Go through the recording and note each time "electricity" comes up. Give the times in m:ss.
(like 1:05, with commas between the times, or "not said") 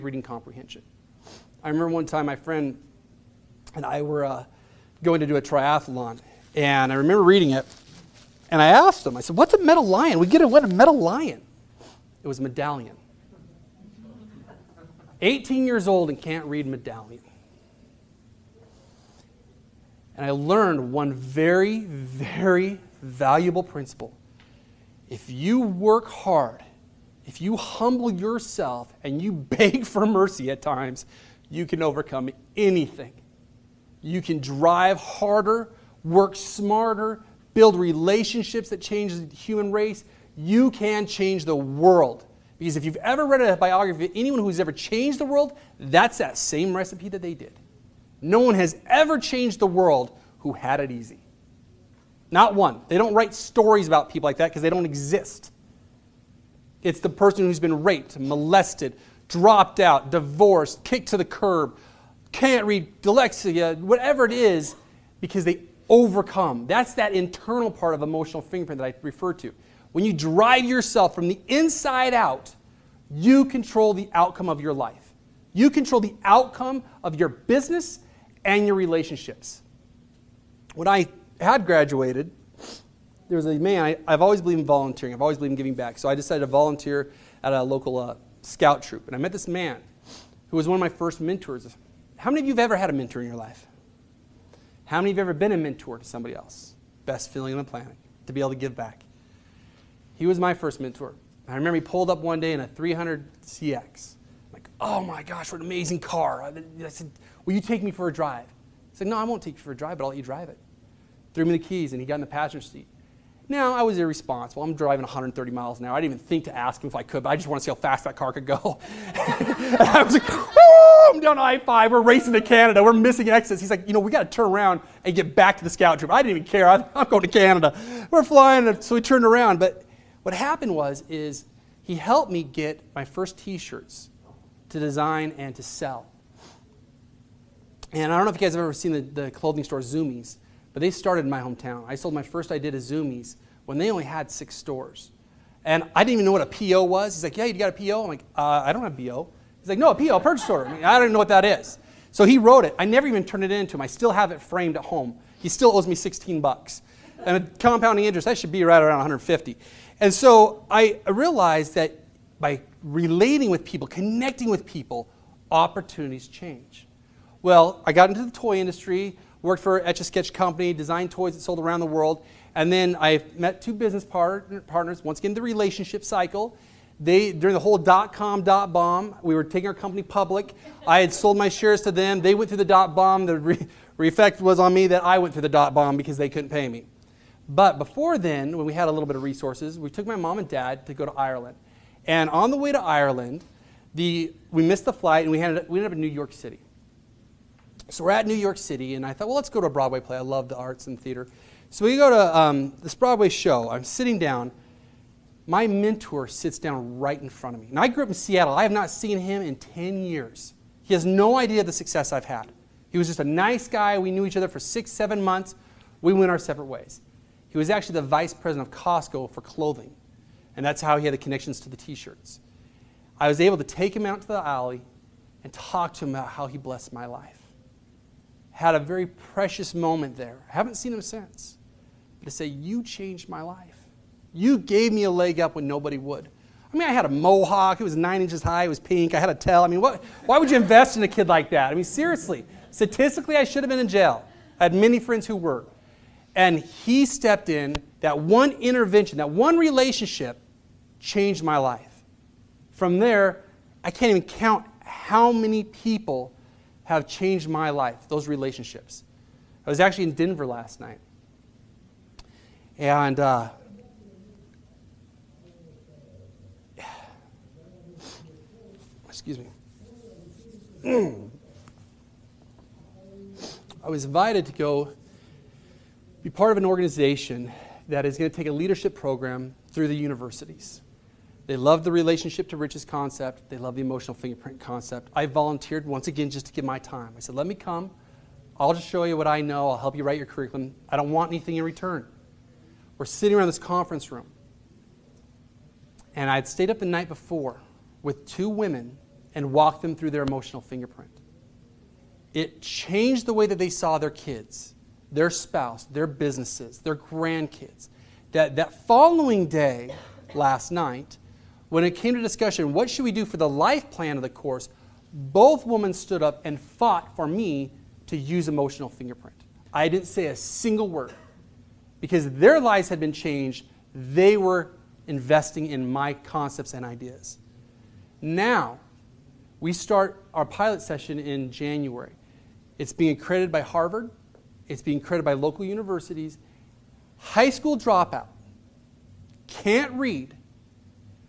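not said.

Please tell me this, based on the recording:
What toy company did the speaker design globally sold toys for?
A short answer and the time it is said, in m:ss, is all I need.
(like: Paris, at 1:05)
Etch a Sketch, at 2:49.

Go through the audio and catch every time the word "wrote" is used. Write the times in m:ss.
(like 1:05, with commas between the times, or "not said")
2:32.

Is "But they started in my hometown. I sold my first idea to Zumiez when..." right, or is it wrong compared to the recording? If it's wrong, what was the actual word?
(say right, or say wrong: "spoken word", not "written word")
right.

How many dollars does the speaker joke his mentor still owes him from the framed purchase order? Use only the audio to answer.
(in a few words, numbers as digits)
16.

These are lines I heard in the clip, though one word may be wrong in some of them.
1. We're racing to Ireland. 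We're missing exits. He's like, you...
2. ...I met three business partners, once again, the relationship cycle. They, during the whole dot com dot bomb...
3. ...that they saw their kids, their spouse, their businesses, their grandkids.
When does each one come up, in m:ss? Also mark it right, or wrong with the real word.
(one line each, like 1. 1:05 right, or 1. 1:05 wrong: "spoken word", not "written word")
1. 2:01 wrong: "Canada", not "Ireland"
2. 2:52 wrong: "two", not "three"
3. 5:03 right.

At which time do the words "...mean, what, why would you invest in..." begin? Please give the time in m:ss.
3:59.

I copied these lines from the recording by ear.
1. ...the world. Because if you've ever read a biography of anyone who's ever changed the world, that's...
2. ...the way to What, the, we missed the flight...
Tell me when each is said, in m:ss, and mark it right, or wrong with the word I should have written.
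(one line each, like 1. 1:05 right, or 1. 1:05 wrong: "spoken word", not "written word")
1. 0:41 right
2. 3:12 wrong: "Ireland", not "What".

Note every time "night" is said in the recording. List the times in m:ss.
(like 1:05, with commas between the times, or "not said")
4:20, 4:56, 5:10.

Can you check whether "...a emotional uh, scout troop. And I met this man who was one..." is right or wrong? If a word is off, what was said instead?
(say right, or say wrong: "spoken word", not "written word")
wrong: "local", not "emotional".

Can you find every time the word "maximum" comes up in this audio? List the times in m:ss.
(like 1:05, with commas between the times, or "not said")
not said.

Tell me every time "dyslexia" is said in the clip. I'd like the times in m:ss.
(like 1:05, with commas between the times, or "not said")
1:03.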